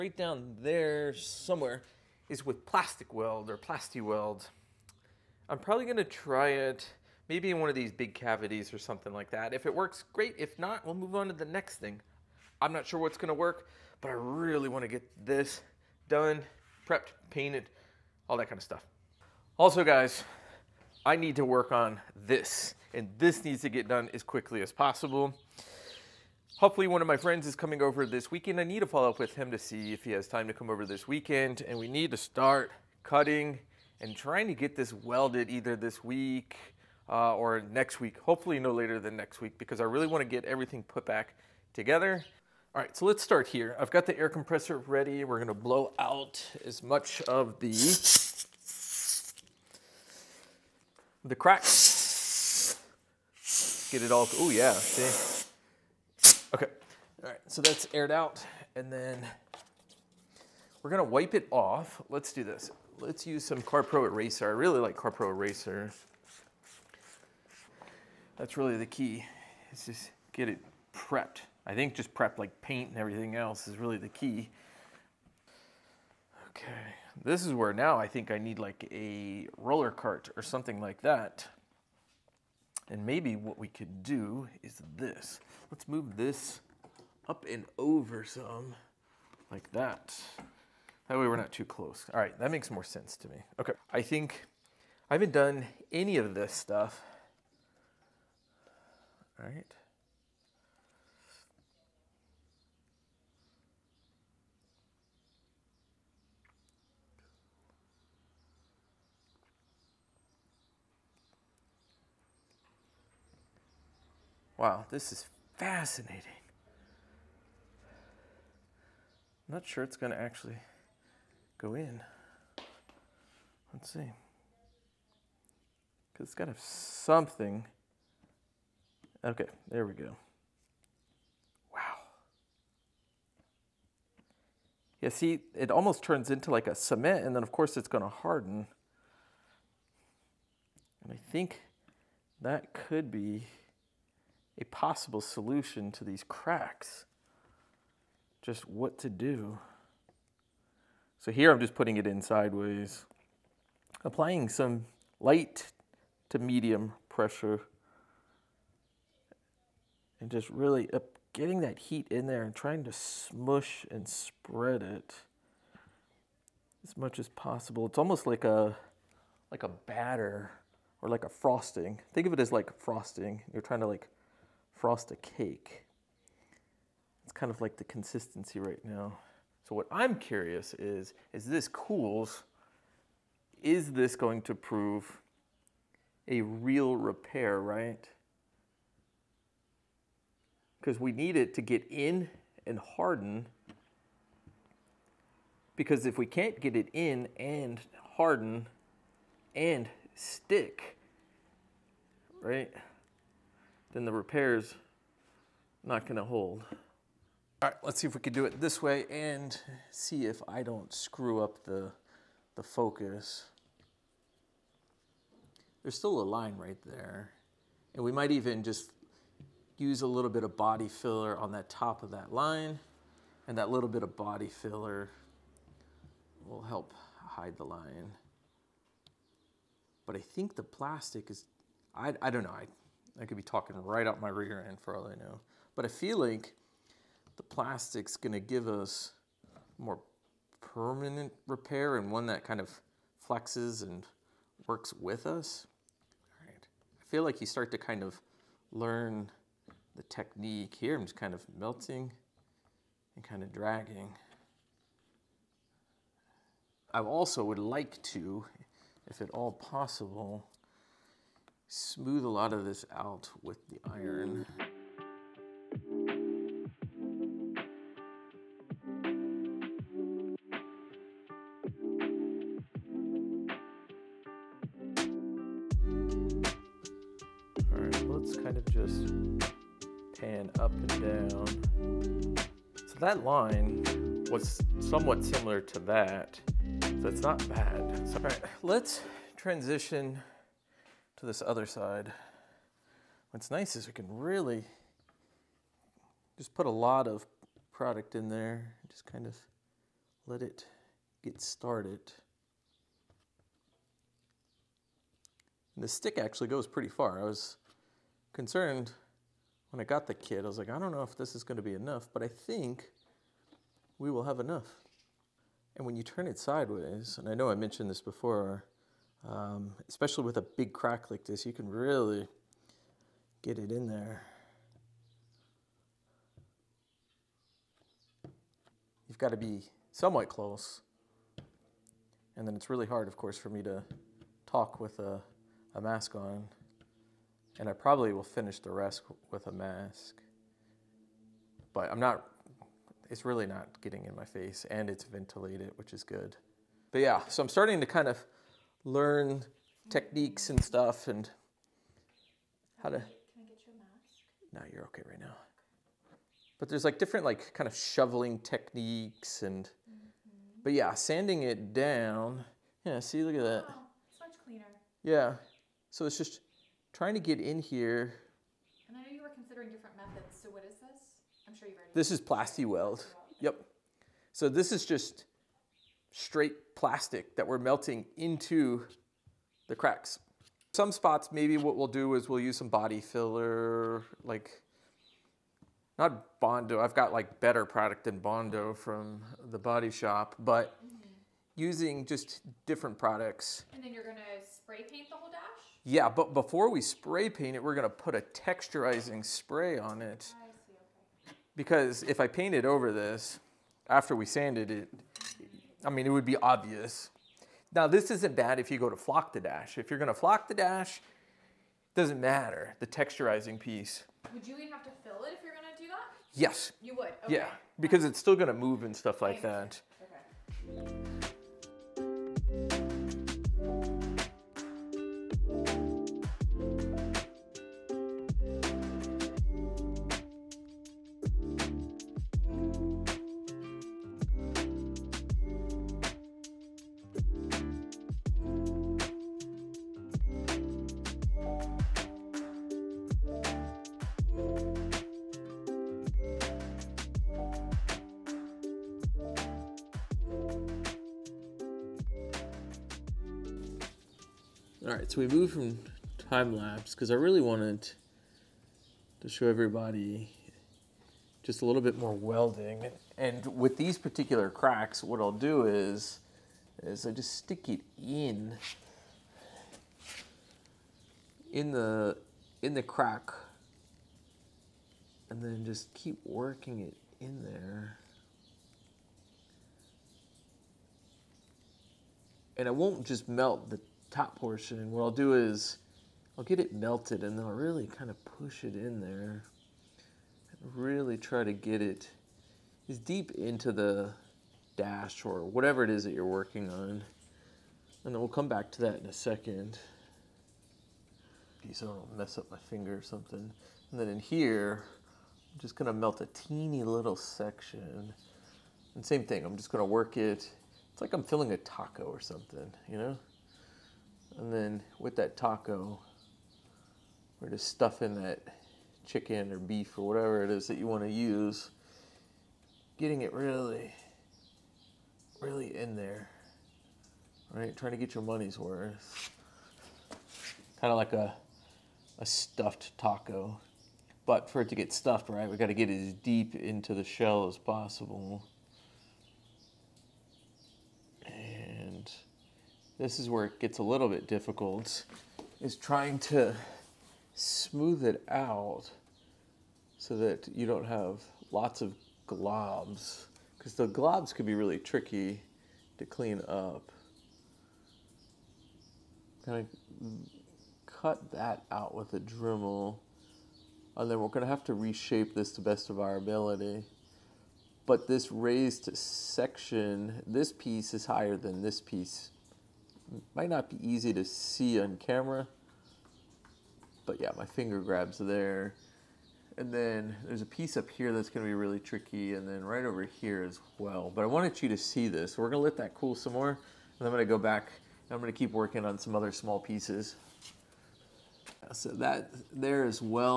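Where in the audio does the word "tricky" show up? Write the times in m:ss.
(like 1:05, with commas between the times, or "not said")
9:14, 9:41.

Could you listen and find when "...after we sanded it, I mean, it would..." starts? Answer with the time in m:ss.
6:43.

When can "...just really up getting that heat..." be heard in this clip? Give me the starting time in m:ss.
2:40.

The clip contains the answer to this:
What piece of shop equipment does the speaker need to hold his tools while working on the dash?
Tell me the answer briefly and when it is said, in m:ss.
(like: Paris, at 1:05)
Roller cart, at 1:19.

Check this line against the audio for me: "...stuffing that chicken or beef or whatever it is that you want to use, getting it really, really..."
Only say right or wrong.
right.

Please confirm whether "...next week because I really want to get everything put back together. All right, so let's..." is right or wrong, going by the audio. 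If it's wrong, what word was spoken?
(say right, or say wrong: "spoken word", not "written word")
right.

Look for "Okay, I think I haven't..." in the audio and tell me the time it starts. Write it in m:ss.
1:33.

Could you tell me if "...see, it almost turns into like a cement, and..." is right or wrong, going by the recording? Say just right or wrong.
right.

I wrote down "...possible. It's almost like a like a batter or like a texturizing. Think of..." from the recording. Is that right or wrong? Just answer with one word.
wrong.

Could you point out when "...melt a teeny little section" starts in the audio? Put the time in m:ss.
8:25.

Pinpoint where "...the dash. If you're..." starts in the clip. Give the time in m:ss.
6:49.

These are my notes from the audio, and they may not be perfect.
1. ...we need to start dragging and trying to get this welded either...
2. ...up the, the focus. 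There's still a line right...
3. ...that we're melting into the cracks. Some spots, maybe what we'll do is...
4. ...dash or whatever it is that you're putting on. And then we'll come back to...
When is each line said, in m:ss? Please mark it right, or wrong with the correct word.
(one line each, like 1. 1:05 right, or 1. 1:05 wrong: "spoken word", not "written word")
1. 0:31 wrong: "cutting", not "dragging"
2. 3:31 right
3. 6:17 right
4. 8:14 wrong: "working", not "putting".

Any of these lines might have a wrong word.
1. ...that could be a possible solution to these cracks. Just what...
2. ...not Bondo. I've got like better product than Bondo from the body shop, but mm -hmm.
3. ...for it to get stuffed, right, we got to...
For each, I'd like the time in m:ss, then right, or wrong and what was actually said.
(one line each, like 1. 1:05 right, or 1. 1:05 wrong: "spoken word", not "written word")
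1. 2:22 right
2. 6:25 right
3. 8:54 right.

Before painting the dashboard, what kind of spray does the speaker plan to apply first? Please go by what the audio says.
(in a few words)
Texturizing spray.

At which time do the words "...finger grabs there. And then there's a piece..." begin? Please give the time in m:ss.
9:37.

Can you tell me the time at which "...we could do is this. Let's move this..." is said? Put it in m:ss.
1:23.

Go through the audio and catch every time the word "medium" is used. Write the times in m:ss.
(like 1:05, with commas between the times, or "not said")
2:36.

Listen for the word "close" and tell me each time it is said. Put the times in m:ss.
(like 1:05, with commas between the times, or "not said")
1:31, 5:30.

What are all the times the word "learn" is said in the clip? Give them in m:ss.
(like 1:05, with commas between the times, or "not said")
4:08, 5:48.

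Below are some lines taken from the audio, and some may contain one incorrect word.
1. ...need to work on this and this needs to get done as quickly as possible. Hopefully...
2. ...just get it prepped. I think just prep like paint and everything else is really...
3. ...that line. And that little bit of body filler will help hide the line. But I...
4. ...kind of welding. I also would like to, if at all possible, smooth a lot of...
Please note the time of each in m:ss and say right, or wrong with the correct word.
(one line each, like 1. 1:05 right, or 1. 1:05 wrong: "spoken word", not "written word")
1. 0:21 right
2. 1:09 right
3. 3:42 right
4. 4:13 wrong: "dragging", not "welding".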